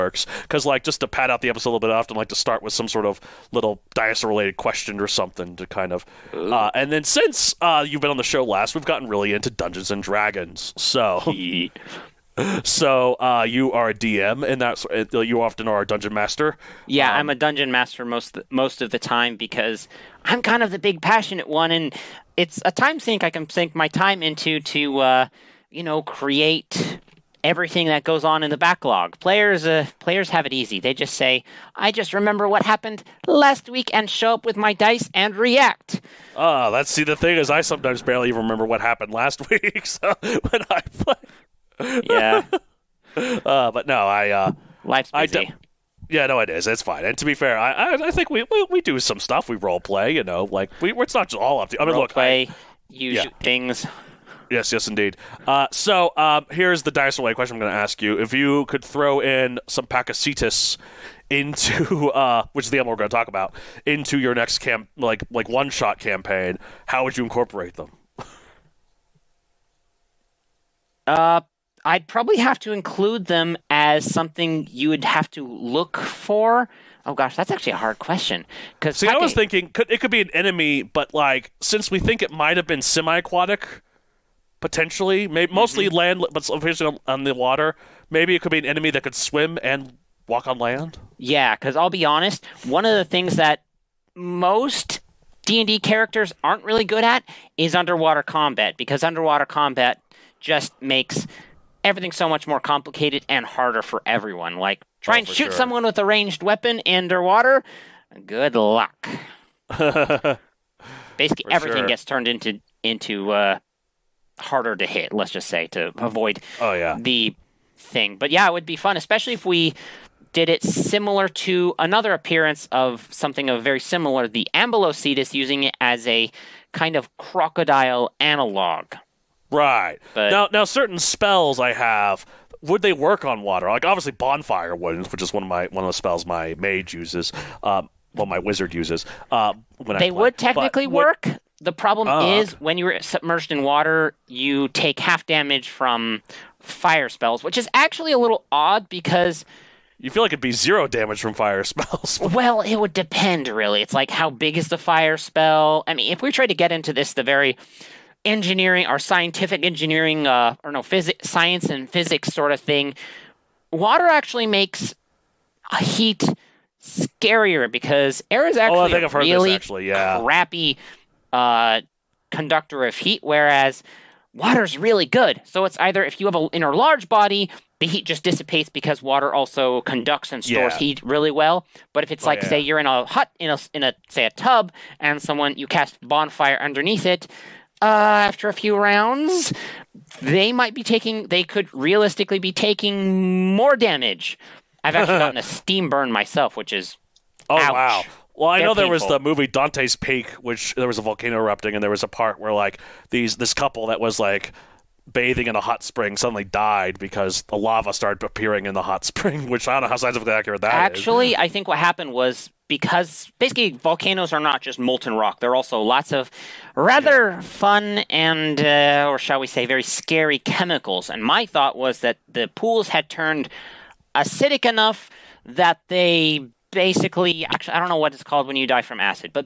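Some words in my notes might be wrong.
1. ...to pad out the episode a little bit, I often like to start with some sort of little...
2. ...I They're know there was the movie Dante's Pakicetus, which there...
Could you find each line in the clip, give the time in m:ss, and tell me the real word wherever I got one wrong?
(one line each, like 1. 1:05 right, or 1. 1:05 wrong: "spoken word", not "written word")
1. 0:00 right
2. 3:18 wrong: "Peak", not "Pakicetus".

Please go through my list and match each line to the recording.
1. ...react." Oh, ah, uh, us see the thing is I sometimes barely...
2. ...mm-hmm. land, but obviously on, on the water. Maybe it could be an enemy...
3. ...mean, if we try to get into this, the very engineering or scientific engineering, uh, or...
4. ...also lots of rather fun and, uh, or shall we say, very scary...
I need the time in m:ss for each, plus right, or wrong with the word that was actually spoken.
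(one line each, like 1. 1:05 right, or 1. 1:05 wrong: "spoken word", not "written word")
1. 0:35 right
2. 1:25 right
3. 2:35 right
4. 3:35 right.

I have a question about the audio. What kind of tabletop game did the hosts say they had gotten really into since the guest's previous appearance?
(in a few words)
Dungeons and Dragons.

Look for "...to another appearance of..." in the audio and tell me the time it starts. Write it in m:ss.
2:01.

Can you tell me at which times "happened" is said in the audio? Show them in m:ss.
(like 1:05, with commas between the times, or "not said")
0:32, 0:38, 3:31.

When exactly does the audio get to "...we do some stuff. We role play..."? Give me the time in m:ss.
0:48.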